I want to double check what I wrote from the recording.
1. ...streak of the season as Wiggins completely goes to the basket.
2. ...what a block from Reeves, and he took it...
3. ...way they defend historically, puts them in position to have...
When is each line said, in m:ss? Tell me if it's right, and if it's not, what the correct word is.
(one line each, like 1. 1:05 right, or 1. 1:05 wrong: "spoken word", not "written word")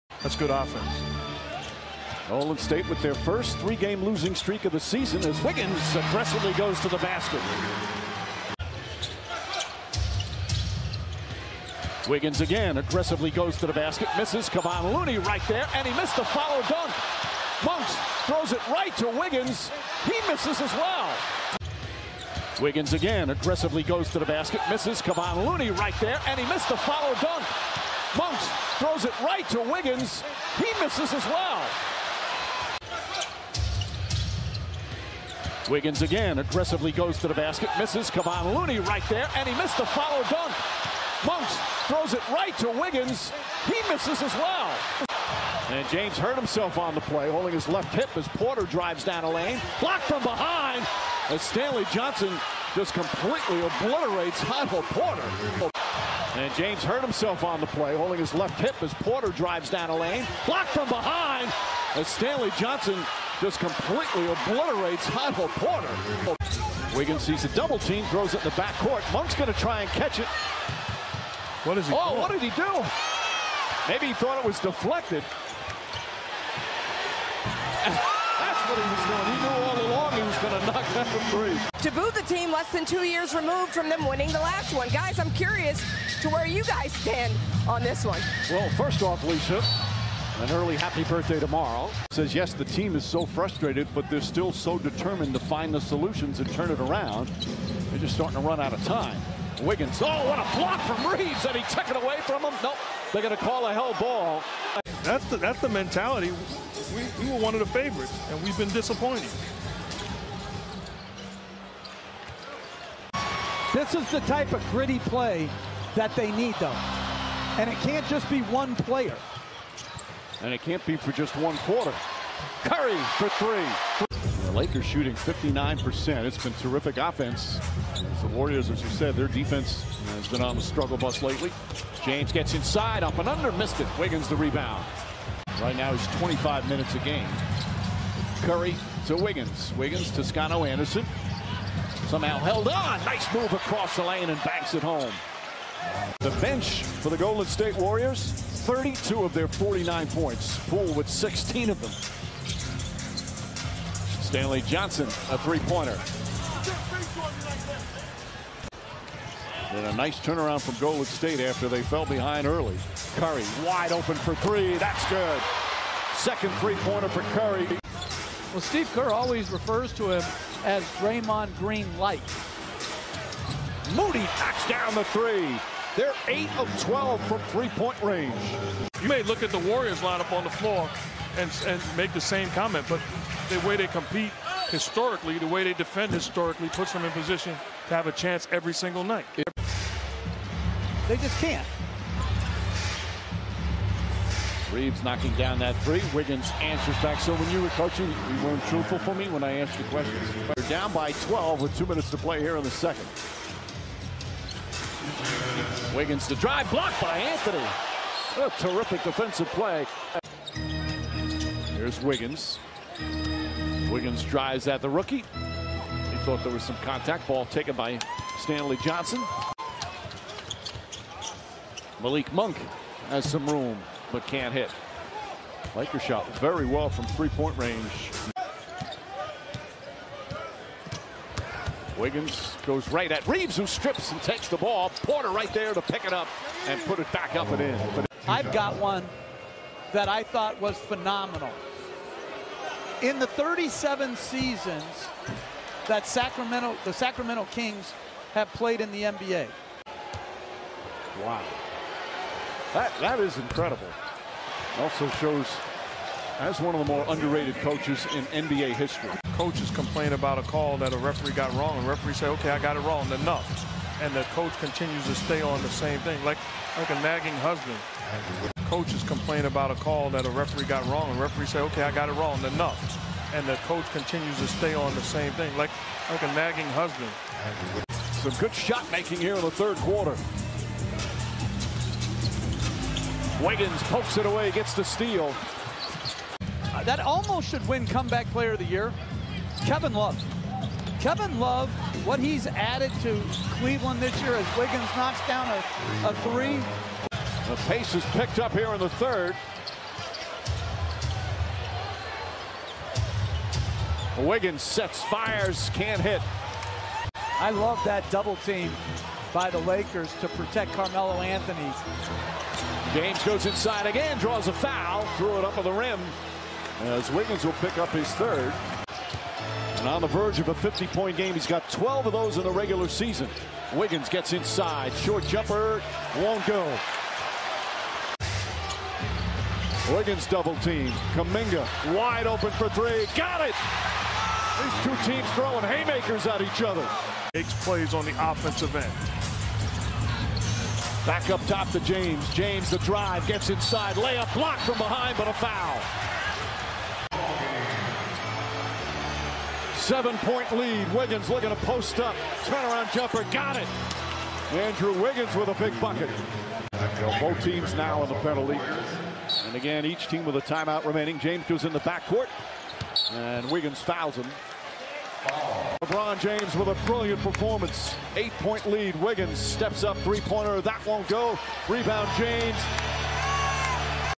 1. 0:04 wrong: "aggressively", not "completely"
2. 1:40 right
3. 3:05 right.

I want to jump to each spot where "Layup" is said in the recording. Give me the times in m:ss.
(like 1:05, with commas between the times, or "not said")
5:43.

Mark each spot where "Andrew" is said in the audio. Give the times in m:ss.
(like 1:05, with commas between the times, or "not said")
5:54.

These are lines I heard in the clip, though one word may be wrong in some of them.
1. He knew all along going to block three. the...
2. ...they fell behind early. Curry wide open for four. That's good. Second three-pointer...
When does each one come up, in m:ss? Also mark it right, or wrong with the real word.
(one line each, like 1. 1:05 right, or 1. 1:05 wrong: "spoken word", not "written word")
1. 1:19 wrong: "knock", not "block"
2. 2:41 wrong: "three", not "four".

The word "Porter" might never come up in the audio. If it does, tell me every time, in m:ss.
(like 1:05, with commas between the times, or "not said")
0:48, 0:54, 0:58, 1:05, 3:55.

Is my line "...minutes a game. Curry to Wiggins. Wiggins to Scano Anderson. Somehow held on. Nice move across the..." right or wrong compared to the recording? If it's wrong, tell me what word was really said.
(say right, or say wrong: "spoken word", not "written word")
right.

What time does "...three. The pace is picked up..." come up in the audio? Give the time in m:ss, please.
4:56.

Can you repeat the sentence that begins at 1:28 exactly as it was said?
Well, first off, Lisa, an early happy birthday tomorrow.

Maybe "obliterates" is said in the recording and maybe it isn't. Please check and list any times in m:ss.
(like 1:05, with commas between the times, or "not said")
0:53, 1:04.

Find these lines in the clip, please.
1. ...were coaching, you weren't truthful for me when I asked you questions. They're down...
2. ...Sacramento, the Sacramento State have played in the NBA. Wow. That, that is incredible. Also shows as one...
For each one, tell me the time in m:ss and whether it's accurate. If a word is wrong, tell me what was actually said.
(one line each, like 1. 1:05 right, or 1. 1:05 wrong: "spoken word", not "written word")
1. 3:17 right
2. 4:06 wrong: "Kings", not "State".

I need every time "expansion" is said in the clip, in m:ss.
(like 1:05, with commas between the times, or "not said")
not said.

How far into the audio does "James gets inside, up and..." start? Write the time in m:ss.
2:12.